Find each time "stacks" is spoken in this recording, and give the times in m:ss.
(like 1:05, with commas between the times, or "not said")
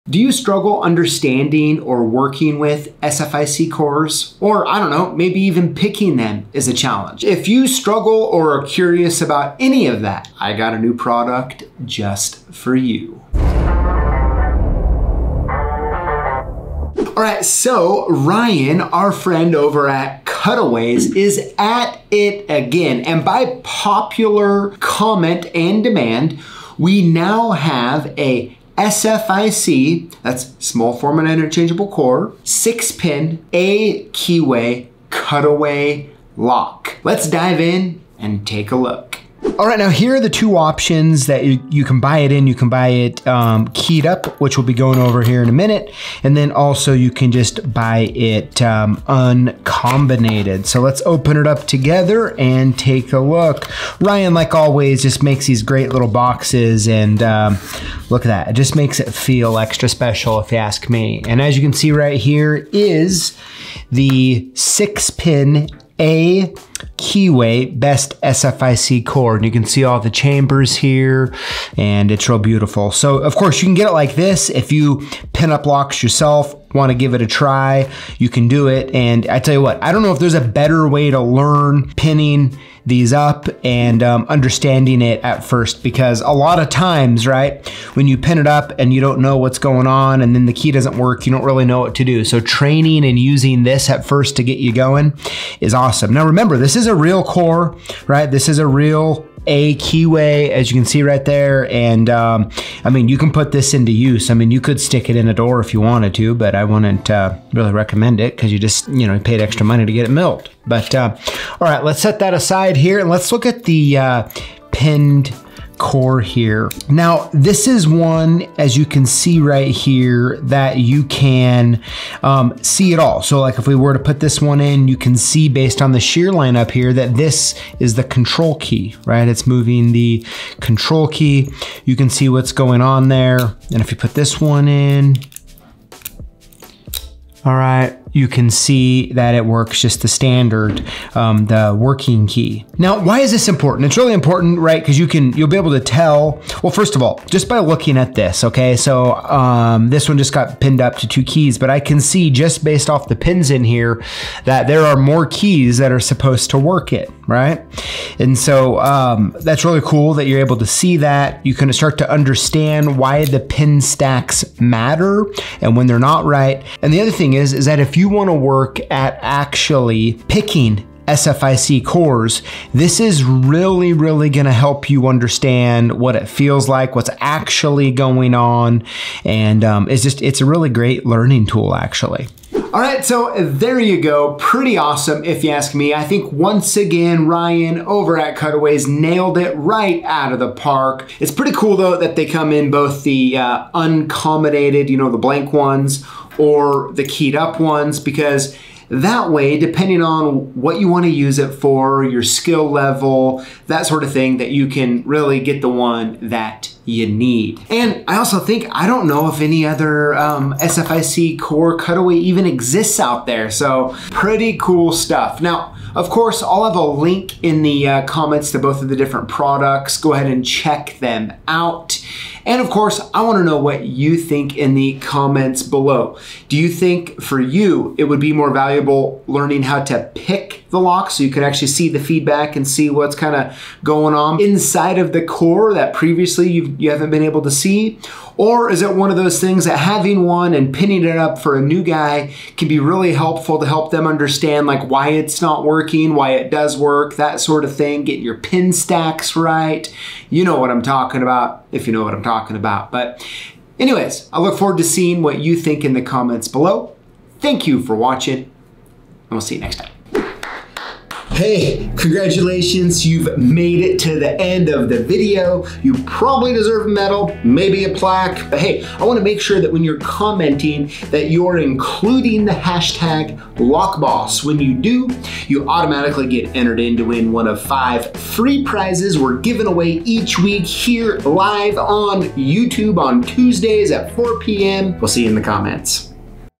2:43, 4:08.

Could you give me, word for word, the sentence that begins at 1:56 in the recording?
Now, this is one, as you can see right here, that you can um, see it all.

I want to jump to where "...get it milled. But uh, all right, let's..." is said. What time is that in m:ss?
1:49.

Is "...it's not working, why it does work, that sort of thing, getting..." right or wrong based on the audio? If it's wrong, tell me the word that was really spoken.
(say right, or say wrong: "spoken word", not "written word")
right.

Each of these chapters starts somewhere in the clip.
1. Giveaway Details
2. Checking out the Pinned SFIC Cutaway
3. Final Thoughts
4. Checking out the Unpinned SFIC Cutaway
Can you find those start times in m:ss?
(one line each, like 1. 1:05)
1. 4:20
2. 1:52
3. 3:02
4. 0:39.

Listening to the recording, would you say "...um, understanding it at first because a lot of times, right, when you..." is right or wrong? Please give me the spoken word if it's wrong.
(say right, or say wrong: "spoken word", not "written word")
right.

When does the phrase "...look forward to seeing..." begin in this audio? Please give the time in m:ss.
4:14.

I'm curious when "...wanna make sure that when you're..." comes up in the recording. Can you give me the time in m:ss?
4:29.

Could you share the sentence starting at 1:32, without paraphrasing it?
So training and using this at first to get you going is awesome.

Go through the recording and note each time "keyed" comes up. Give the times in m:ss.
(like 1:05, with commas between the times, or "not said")
0:43, 3:17.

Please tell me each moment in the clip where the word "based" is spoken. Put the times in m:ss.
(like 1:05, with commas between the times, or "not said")
2:05, 2:32.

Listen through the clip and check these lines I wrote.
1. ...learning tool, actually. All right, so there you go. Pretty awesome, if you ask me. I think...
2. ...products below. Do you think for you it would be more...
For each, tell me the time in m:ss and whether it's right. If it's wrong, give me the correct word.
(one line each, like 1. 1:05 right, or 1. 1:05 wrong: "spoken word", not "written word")
1. 3:01 right
2. 3:44 wrong: "comments", not "products".